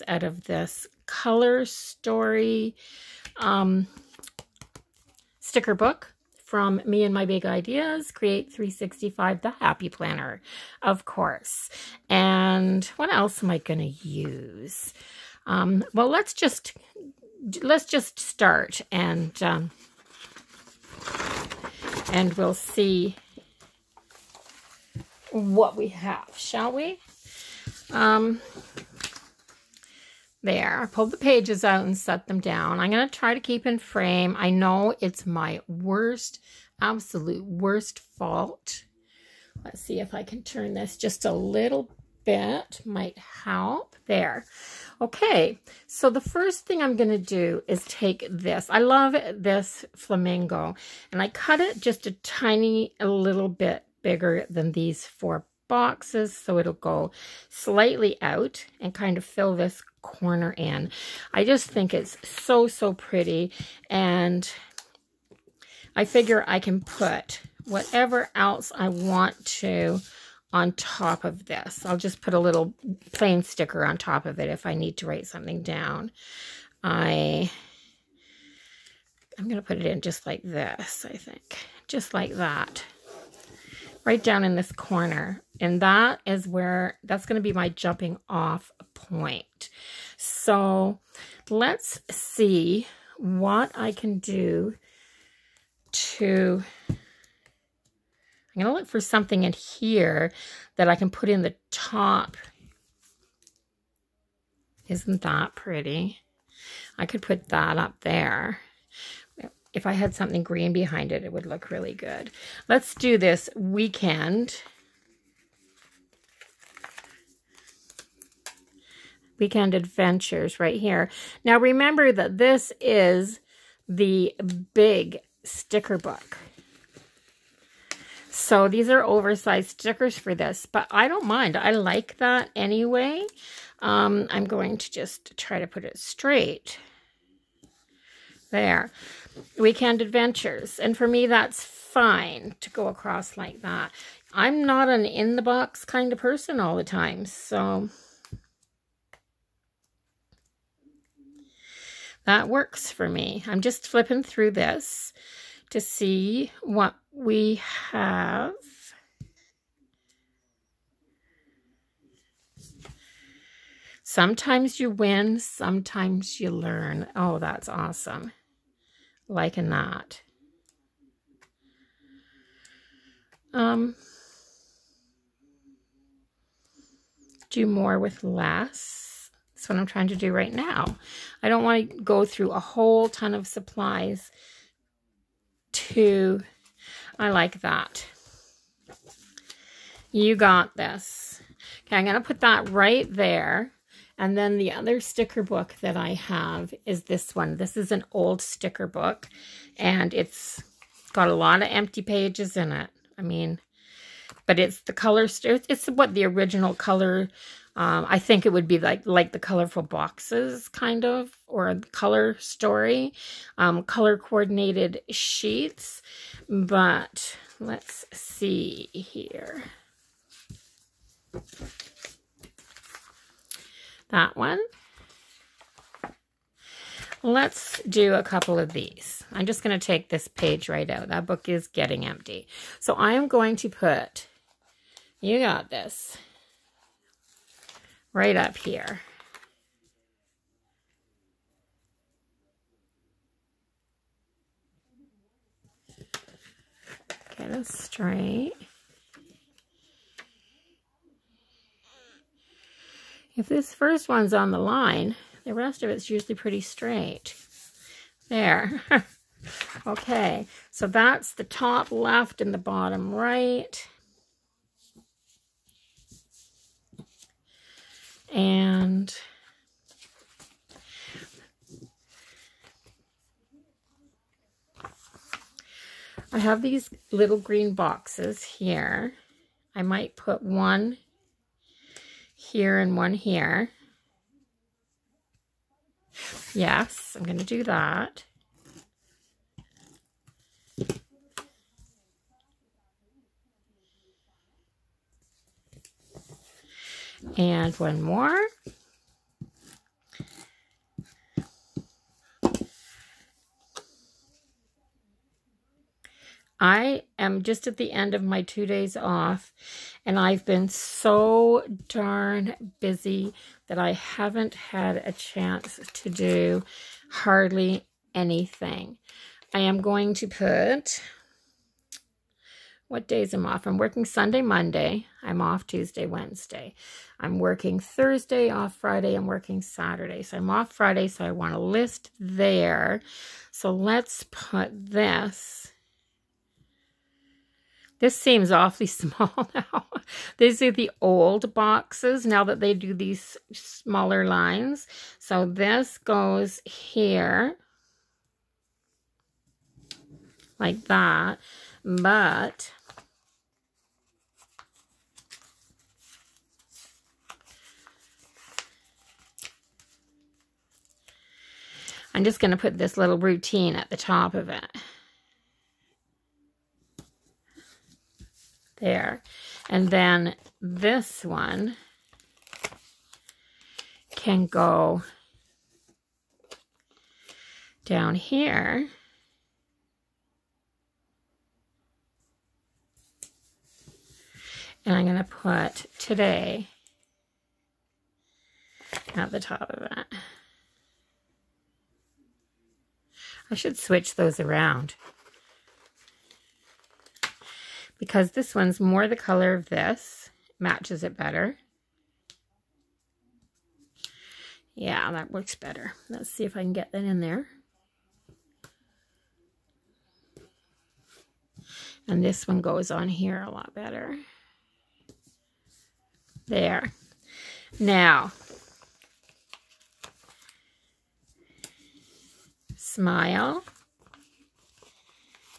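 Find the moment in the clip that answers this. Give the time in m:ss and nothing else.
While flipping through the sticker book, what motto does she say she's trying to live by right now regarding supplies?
2:57.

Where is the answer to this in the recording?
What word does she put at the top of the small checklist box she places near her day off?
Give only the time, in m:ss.
6:03.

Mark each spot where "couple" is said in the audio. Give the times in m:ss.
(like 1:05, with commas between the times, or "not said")
3:48.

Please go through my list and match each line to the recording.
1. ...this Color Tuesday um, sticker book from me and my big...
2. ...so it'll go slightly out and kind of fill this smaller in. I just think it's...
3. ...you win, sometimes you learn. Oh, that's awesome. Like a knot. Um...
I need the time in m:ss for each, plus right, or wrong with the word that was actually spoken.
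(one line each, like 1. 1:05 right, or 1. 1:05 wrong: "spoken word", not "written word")
1. 0:00 wrong: "Story", not "Tuesday"
2. 0:56 wrong: "corner", not "smaller"
3. 2:44 right.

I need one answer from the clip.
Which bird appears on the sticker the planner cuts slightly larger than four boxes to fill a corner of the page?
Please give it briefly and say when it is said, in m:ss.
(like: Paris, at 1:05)
Flamingo, at 0:49.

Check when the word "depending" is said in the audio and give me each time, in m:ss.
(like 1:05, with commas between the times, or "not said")
not said.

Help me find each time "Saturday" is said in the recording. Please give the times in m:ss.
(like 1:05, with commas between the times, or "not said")
5:29.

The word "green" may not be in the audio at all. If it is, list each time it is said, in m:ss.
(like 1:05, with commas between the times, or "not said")
1:50, 4:37.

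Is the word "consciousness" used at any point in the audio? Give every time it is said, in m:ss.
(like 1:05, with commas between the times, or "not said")
not said.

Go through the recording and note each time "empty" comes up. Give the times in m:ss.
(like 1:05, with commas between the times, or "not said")
3:21, 3:52.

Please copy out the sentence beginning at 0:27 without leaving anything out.
Um, there, I pulled the pages out and set them down.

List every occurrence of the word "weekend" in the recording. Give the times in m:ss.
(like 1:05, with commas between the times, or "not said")
1:53, 1:59, 2:19.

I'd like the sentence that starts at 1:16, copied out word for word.
I, I'm going to put it in just like this, I think.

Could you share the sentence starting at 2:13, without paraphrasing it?
Um, I'm going to just try to put it straight.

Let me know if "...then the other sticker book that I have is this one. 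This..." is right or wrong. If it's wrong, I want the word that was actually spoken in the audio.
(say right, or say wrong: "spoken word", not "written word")
right.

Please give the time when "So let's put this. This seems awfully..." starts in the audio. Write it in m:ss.
5:33.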